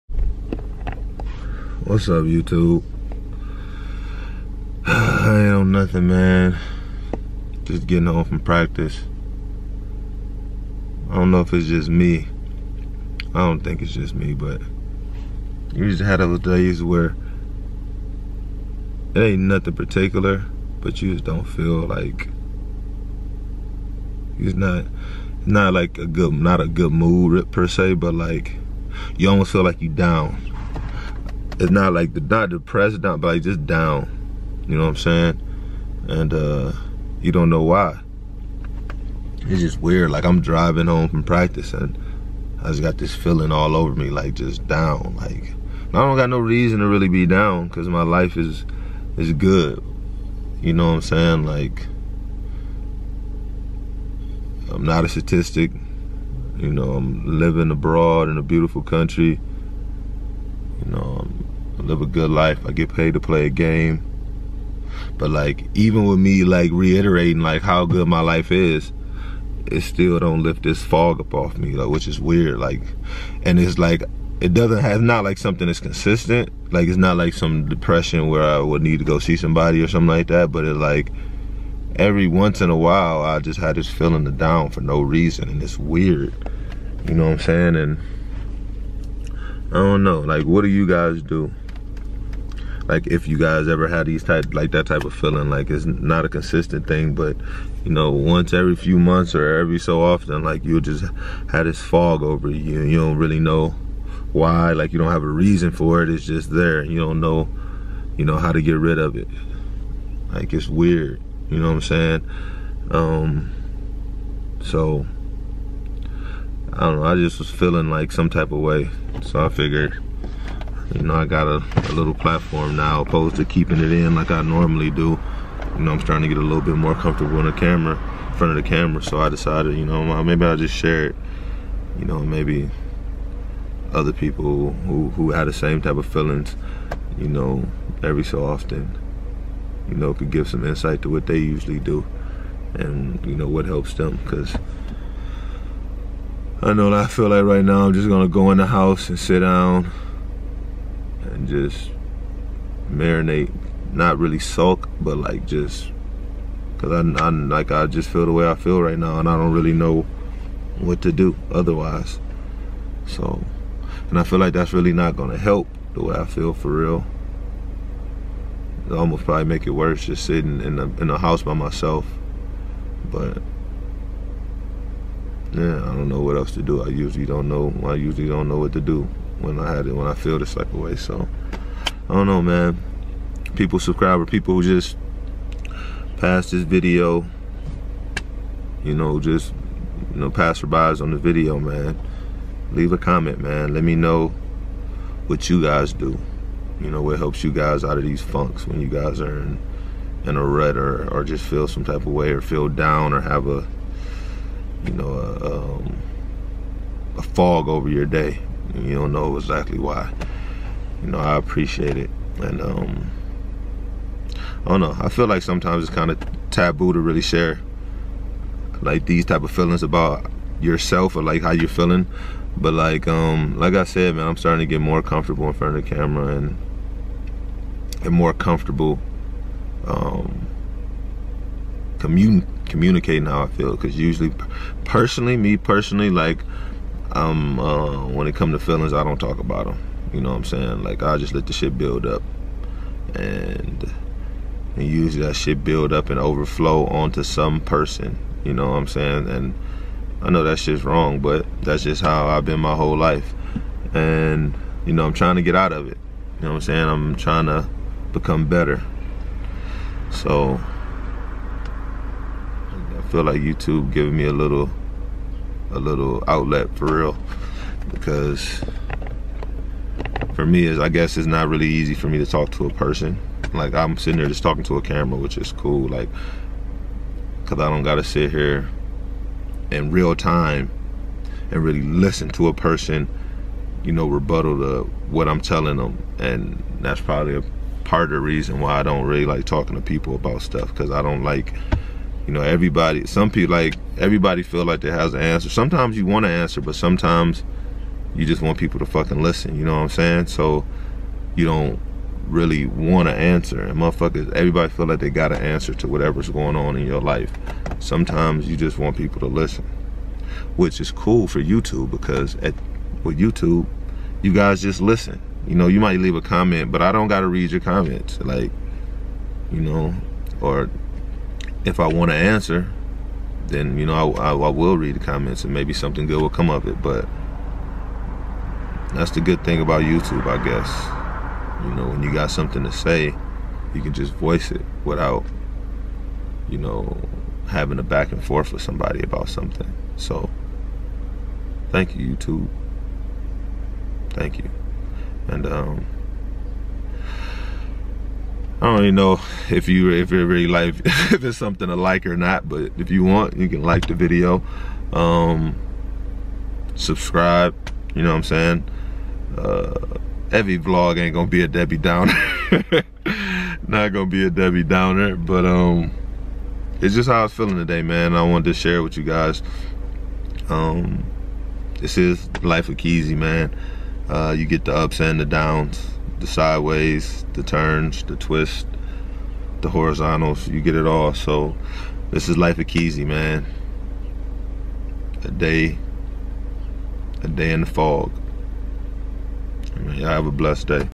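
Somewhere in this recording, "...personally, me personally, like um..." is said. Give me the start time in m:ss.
3:54.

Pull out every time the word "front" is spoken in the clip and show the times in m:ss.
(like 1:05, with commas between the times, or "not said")
2:08, 3:45.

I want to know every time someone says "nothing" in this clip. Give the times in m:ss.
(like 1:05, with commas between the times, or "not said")
0:05, 0:19.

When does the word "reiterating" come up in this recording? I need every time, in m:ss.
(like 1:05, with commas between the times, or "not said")
1:06.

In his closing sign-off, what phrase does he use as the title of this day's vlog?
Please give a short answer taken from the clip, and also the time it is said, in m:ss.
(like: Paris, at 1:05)
A day in the fog, at 6:27.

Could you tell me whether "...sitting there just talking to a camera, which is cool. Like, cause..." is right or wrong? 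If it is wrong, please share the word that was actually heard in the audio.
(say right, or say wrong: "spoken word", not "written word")
right.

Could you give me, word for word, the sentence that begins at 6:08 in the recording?
I wanted to share with you guys.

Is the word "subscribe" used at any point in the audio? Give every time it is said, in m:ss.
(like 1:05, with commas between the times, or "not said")
3:03, 5:56.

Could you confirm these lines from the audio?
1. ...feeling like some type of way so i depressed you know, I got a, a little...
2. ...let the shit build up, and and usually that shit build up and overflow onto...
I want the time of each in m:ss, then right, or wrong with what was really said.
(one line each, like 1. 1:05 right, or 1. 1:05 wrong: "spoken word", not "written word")
1. 1:57 wrong: "figured", not "depressed"
2. 4:01 right.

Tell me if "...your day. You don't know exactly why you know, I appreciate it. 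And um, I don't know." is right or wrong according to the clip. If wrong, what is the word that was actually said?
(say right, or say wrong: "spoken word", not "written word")
right.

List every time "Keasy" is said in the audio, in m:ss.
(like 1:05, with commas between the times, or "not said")
6:12, 6:22.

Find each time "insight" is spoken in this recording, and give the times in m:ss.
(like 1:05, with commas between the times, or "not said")
2:20.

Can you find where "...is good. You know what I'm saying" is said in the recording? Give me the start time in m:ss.
0:49.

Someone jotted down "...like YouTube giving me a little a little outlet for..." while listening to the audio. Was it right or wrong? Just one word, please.
right.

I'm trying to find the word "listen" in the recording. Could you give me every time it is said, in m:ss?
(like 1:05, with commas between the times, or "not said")
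4:41, 4:59, 5:09, 5:14.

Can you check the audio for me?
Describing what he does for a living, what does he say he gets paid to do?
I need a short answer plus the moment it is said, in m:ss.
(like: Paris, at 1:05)
Play a game, at 1:03.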